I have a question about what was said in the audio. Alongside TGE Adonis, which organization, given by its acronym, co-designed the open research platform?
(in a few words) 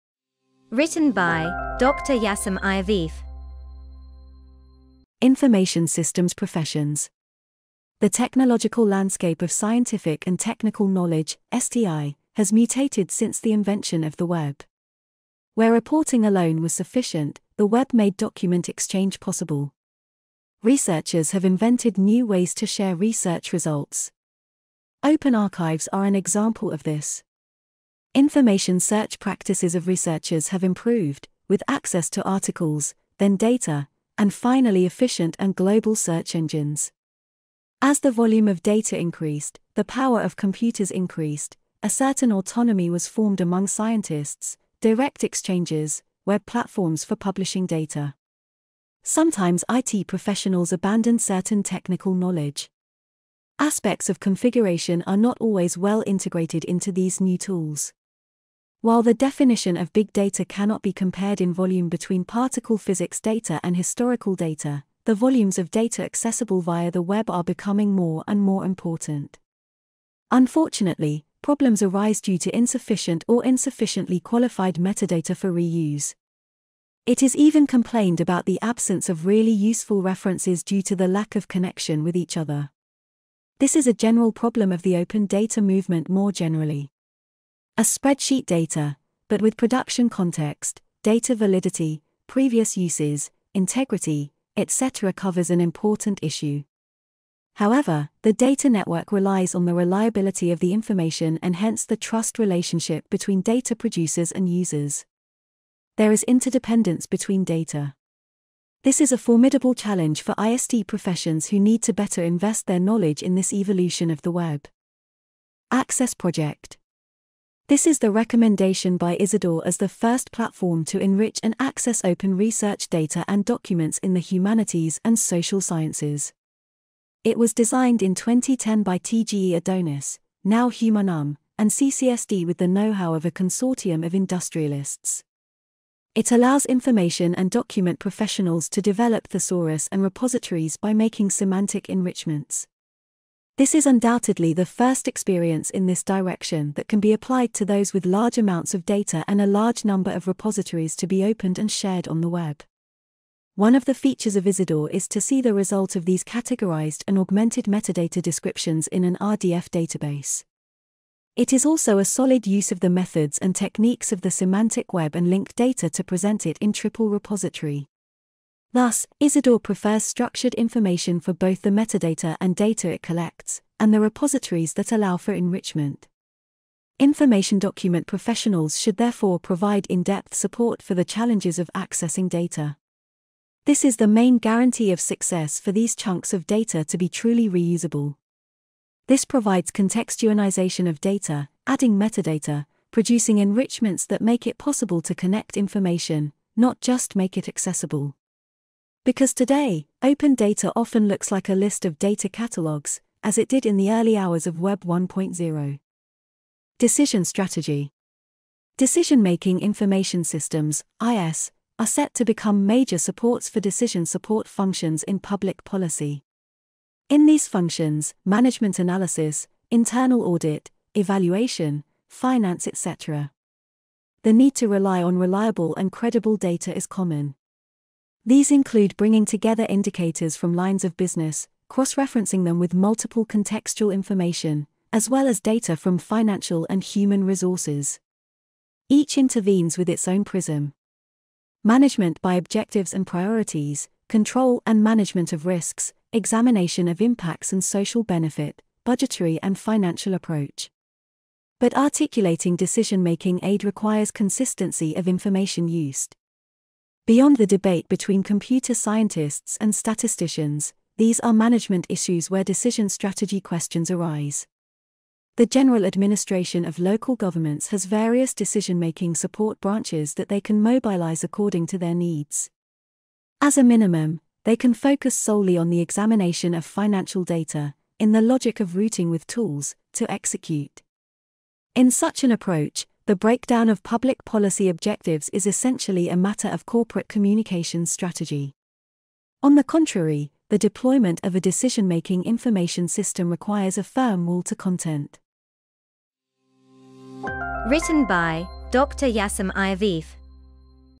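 CCSD.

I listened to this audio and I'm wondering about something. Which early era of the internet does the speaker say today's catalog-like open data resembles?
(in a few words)
Web 1.0.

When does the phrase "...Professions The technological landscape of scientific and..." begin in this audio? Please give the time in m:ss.
0:06.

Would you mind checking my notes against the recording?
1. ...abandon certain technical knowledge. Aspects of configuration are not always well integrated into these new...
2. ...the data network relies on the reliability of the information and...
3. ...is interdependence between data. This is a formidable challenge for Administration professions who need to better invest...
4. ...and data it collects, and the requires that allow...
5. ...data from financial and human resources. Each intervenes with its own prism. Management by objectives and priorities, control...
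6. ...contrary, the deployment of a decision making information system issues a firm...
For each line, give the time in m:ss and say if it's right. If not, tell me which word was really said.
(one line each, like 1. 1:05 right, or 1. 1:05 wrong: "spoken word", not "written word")
1. 0:50 right
2. 1:38 right
3. 1:46 wrong: "ISD", not "Administration"
4. 2:52 wrong: "repositories", not "requires"
5. 3:55 right
6. 4:49 wrong: "requires", not "issues".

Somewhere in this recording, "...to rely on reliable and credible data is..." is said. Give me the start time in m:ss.
3:44.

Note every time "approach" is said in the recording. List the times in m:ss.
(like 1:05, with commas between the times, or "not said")
4:10, 4:42.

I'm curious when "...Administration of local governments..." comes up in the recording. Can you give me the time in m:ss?
4:25.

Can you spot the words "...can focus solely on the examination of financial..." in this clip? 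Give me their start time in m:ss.
4:34.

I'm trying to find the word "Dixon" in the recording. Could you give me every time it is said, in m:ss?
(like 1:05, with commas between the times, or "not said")
not said.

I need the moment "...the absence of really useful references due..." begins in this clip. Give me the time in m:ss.
1:18.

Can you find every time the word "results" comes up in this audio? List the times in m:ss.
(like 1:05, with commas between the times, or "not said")
0:23, 2:35.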